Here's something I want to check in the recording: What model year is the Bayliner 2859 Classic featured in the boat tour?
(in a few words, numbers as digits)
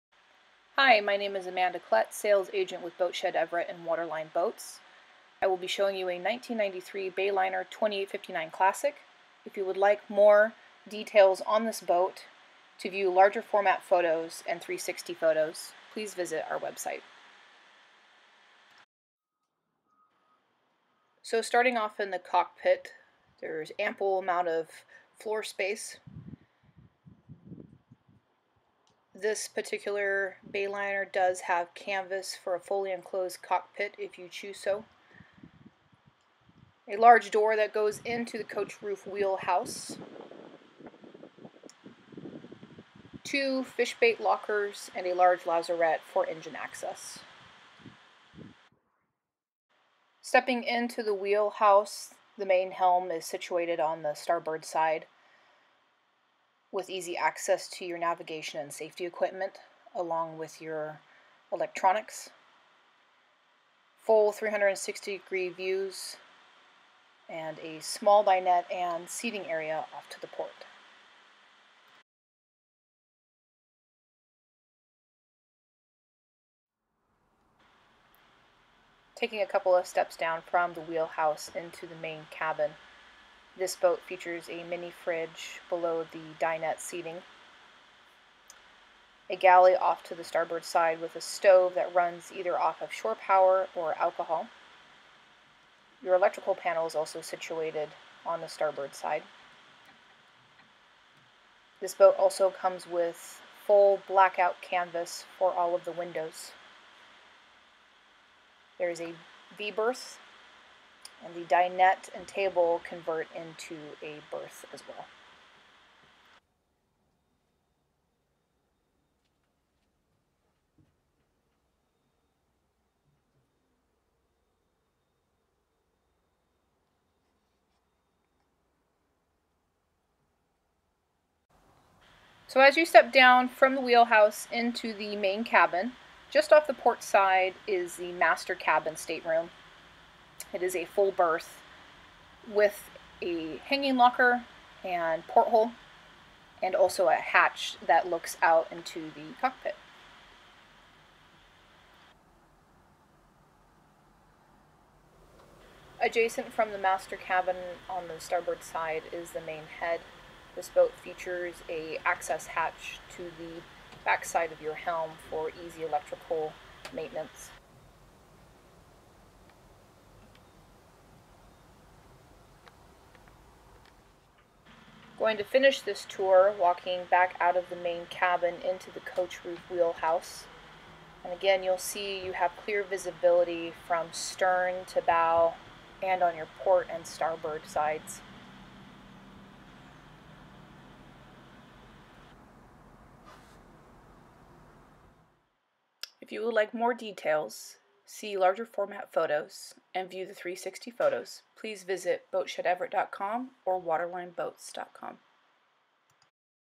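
1993.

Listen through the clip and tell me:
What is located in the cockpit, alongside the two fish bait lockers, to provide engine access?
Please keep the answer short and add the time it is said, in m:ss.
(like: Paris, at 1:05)
Large lazarette, at 0:45.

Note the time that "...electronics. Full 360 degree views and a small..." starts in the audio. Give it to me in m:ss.
1:01.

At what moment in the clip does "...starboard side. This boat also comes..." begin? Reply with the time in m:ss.
1:38.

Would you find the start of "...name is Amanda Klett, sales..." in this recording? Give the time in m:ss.
0:01.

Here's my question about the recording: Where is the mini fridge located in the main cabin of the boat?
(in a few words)
Below the dinette seating.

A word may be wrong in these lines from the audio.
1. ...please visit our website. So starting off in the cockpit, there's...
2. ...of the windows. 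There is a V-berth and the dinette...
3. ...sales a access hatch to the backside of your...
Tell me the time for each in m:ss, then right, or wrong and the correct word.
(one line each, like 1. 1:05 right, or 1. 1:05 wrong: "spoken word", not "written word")
1. 0:15 right
2. 1:45 right
3. 2:41 wrong: "features", not "sales".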